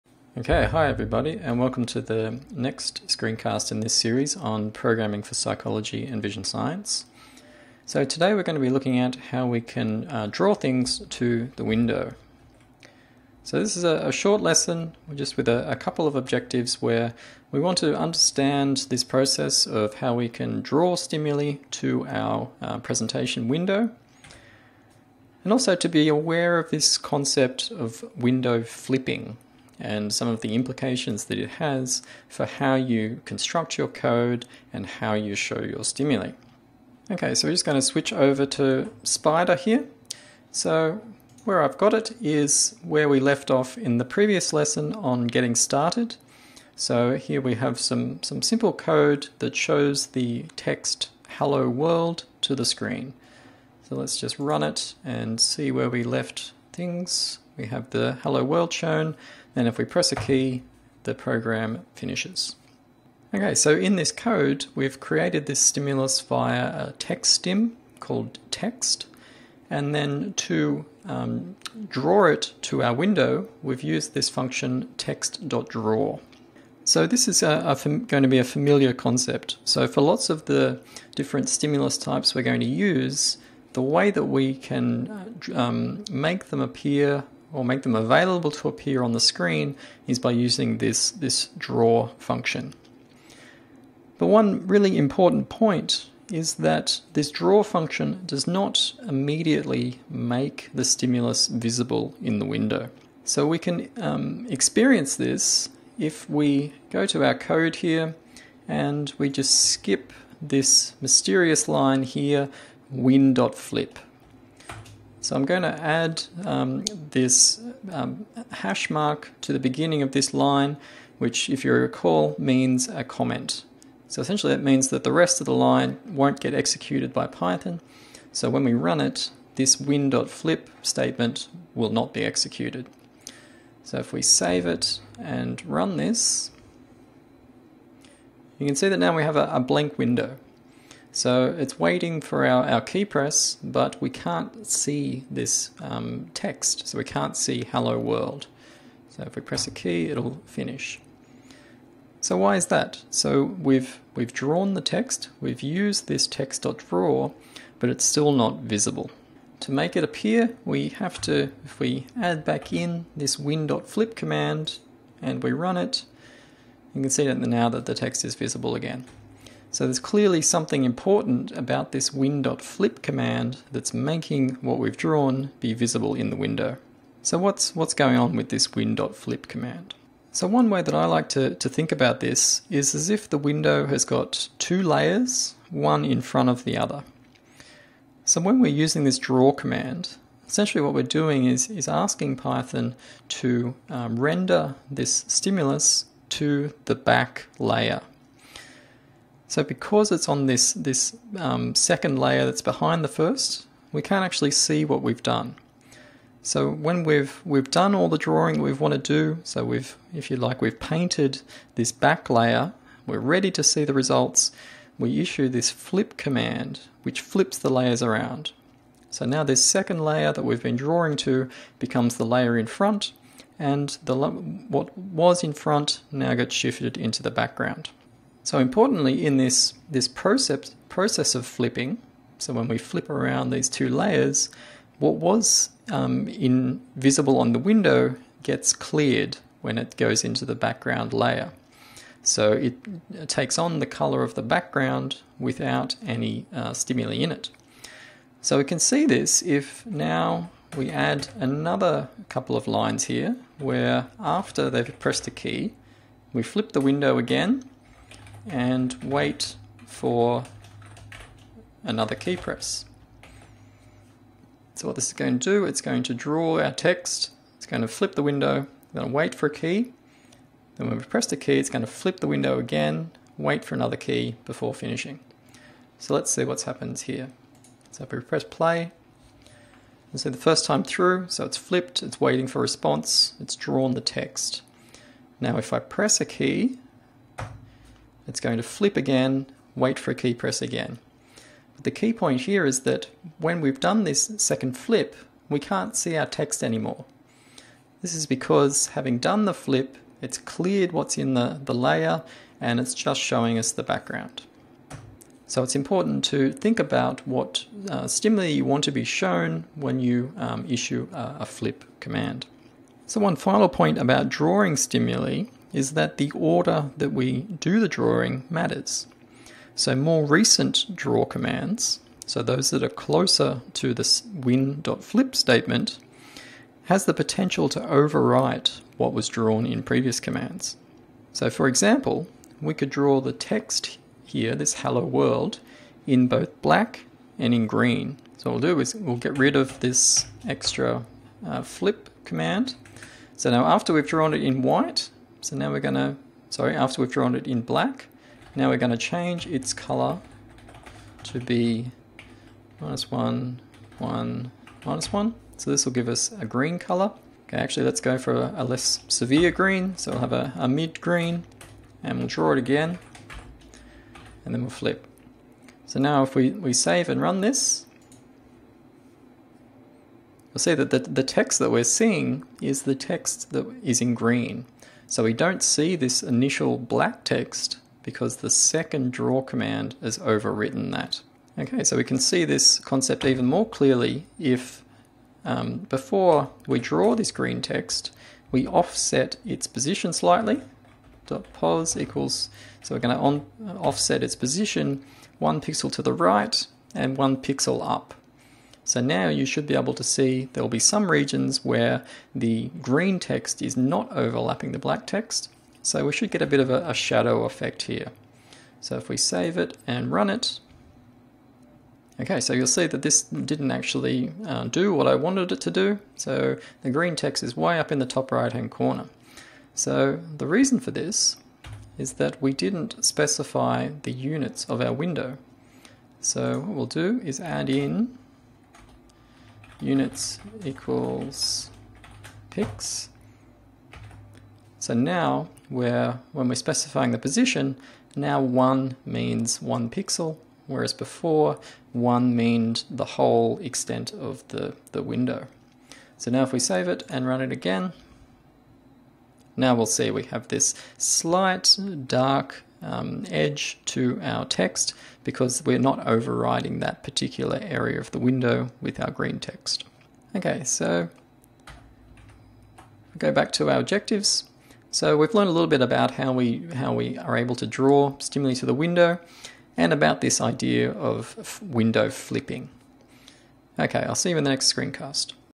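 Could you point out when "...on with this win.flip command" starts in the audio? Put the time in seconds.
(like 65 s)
178 s.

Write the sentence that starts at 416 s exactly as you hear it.
So the green text is way up in the top right hand corner.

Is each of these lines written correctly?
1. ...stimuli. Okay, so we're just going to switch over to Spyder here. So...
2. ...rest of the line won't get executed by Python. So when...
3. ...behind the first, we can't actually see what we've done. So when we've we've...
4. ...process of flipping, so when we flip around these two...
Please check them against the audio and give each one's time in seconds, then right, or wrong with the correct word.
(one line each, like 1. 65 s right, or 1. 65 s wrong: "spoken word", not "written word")
1. 35 s right
2. 125 s right
3. 202 s right
4. 230 s right.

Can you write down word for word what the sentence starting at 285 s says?
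Now if I press a key, it's going to flip again, wait for a key press again.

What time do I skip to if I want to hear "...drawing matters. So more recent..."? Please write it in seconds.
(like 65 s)
317 s.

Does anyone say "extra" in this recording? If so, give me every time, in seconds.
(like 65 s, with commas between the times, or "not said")
340 s.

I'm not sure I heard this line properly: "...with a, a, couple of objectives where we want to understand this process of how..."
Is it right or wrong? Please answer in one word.
right.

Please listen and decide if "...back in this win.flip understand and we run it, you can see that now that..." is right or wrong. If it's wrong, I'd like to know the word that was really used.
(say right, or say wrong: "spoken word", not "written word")
wrong: "command", not "understand".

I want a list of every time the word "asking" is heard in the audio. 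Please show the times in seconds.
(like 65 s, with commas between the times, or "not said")
191 s.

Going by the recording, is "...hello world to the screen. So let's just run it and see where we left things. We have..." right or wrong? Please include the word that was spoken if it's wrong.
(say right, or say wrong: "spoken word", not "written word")
right.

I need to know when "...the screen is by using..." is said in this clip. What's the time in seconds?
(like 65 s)
89 s.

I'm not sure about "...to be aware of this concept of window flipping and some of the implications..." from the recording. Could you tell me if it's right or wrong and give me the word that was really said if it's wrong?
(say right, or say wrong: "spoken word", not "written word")
right.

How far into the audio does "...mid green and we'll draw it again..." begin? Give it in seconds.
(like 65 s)
360 s.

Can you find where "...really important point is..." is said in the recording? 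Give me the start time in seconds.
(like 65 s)
94 s.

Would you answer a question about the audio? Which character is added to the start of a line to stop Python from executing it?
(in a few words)
hash mark.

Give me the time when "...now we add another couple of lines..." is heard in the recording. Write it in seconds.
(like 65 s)
249 s.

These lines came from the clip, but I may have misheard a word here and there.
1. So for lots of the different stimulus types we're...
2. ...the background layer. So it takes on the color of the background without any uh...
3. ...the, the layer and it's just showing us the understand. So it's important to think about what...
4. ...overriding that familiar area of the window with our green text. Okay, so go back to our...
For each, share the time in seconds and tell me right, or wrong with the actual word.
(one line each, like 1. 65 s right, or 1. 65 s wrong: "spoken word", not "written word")
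1. 79 s right
2. 240 s right
3. 301 s wrong: "background", not "understand"
4. 456 s wrong: "particular", not "familiar".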